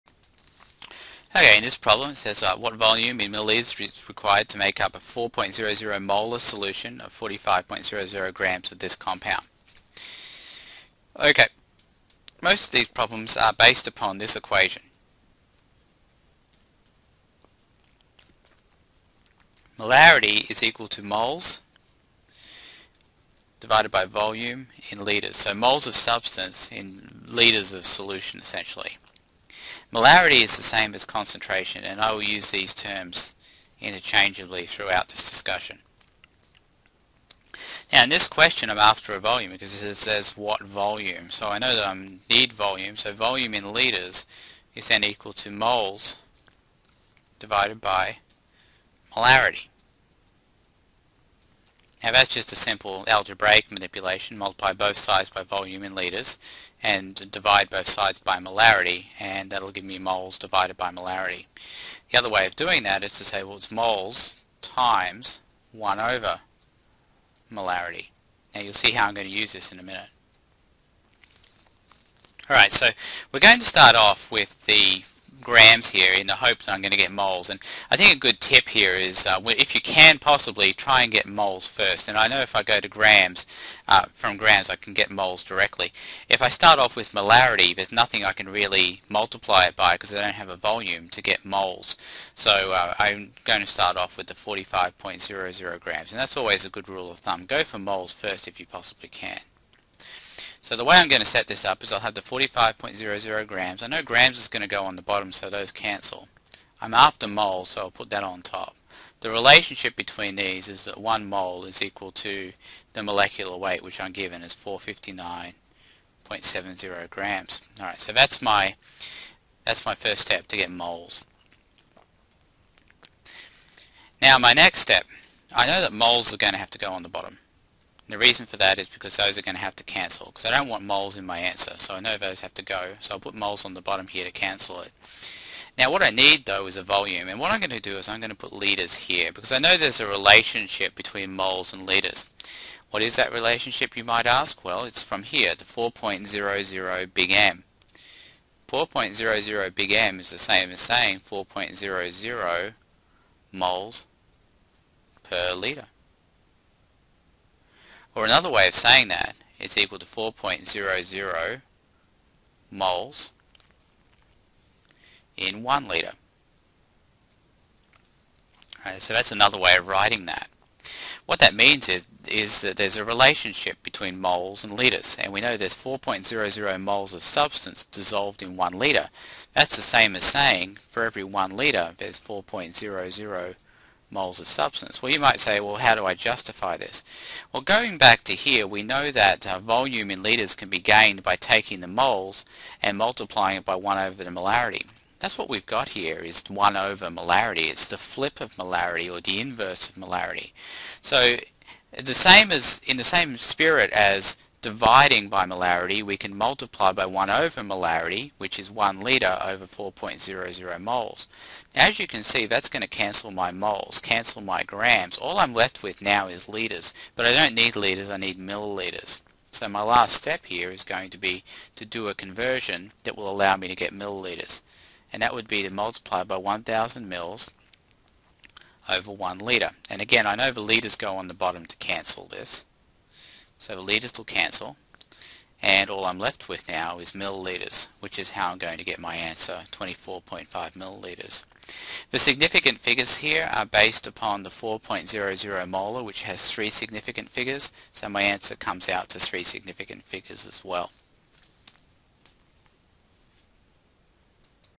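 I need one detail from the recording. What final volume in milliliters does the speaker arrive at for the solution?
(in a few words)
24.5 milliliters.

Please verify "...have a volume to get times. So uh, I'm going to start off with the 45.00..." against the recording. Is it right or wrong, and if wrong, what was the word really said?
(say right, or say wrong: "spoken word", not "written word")
wrong: "moles", not "times".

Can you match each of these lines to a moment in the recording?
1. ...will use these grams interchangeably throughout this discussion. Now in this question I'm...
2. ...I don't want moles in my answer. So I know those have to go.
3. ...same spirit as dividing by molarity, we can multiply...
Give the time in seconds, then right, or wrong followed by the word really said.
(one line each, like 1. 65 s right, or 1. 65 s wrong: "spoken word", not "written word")
1. 32 s wrong: "terms", not "grams"
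2. 130 s right
3. 203 s right.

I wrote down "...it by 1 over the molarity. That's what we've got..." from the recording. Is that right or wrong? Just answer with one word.
right.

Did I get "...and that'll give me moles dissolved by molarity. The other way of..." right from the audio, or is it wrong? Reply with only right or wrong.
wrong.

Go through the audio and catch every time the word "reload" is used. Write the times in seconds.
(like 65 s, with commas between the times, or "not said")
not said.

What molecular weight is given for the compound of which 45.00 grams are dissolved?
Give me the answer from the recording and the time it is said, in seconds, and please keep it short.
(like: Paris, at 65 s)
459.70 grams, at 114 s.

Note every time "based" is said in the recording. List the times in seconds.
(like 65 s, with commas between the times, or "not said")
13 s, 243 s.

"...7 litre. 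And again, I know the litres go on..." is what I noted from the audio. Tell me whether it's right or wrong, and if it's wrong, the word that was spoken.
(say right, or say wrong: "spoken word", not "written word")
wrong: "1", not "7".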